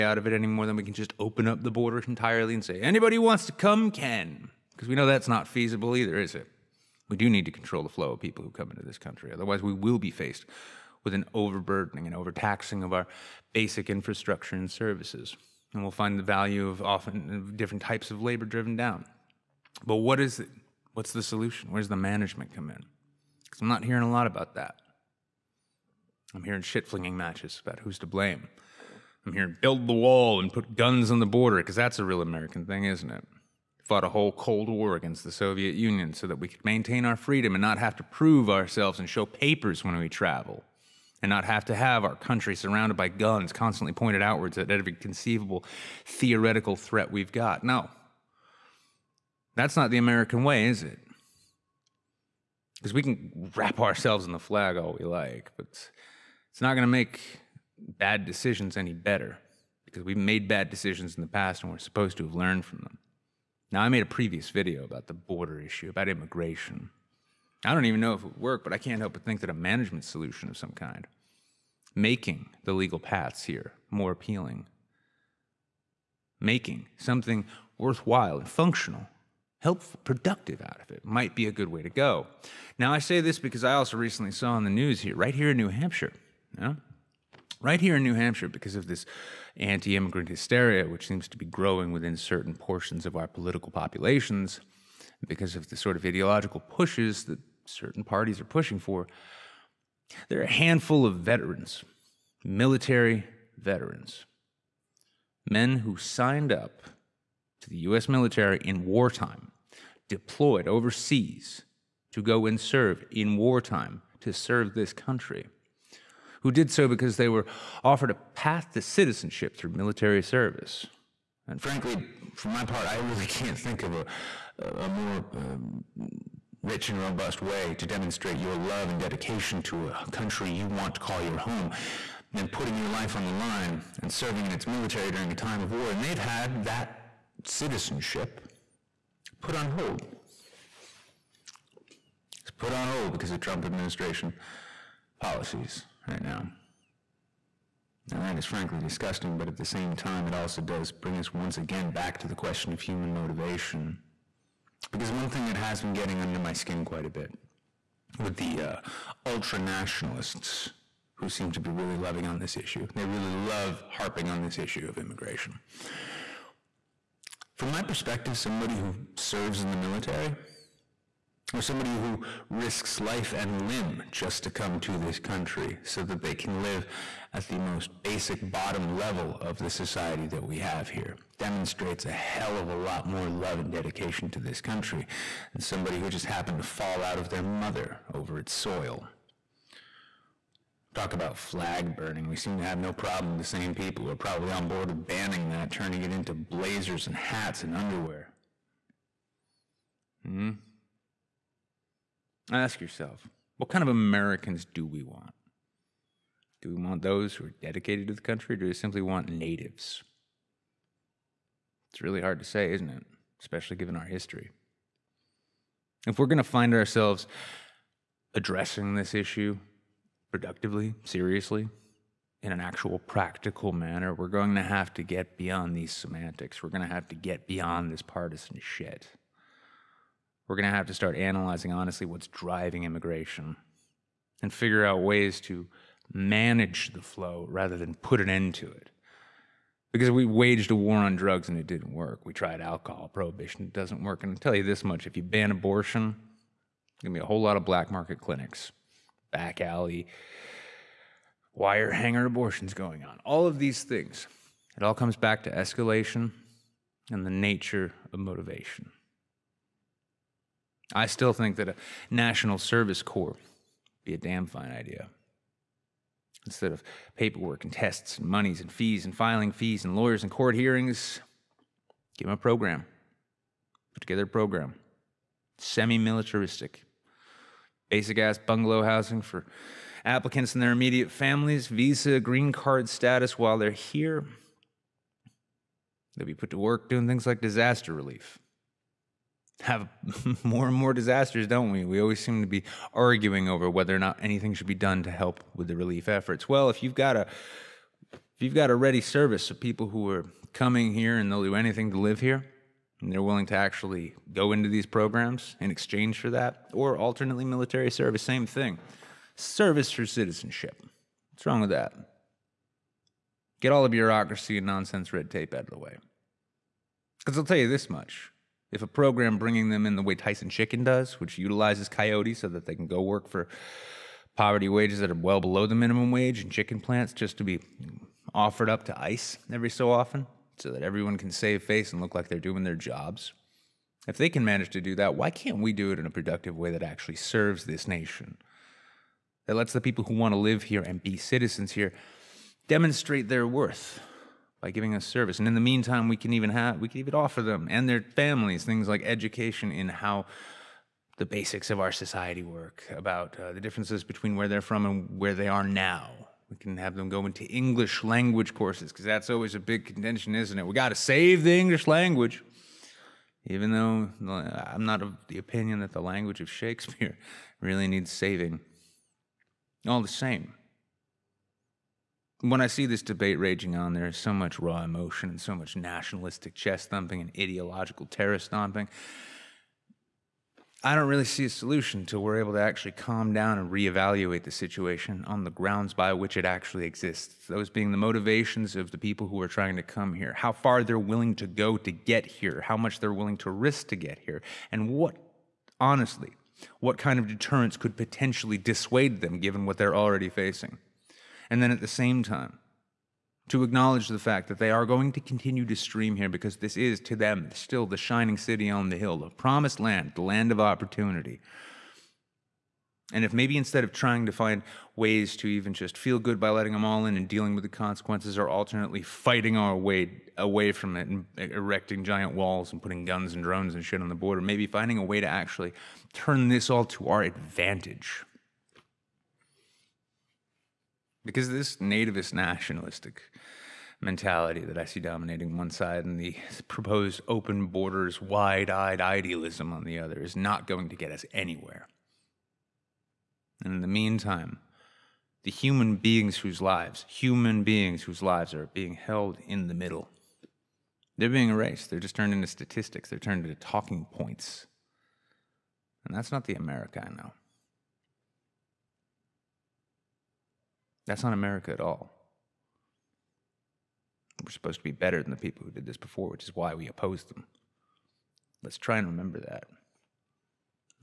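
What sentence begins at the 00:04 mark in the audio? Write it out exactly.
Because we know that's not feasible either, is it?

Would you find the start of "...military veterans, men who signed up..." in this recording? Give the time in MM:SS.
01:42.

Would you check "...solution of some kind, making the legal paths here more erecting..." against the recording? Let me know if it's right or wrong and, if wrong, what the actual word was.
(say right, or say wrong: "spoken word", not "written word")
wrong: "appealing", not "erecting".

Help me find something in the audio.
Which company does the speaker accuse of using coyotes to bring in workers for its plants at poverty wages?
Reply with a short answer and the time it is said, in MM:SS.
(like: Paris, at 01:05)
Tyson Chicken, at 05:20.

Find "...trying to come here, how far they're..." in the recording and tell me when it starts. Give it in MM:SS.
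06:29.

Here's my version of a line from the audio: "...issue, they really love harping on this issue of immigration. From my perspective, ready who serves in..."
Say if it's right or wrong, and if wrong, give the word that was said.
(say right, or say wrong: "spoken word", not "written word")
wrong: "somebody", not "ready".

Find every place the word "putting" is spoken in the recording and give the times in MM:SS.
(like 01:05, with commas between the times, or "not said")
02:12, 07:02.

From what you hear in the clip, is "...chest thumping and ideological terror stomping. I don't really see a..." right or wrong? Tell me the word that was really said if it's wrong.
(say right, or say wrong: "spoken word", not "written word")
right.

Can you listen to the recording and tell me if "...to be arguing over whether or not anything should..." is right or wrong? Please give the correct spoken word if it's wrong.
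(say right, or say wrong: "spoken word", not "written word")
right.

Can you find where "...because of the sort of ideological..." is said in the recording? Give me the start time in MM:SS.
01:35.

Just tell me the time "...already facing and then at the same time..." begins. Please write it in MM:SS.
06:39.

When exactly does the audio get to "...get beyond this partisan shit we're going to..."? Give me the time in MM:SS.
03:47.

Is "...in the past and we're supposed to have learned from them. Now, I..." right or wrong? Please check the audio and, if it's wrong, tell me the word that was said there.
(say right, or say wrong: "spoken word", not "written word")
right.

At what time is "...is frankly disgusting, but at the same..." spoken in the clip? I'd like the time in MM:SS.
02:28.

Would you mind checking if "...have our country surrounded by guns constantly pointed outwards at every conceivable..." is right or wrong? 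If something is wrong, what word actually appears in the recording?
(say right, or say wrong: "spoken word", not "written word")
right.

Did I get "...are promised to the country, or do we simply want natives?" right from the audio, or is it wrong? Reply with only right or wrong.
wrong.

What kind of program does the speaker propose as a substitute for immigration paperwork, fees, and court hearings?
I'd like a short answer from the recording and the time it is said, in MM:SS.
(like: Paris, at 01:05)
National service corps, at 04:22.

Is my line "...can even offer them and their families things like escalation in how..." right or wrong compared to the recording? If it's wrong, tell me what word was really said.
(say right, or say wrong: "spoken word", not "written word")
wrong: "education", not "escalation".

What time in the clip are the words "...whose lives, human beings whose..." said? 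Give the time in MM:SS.
07:26.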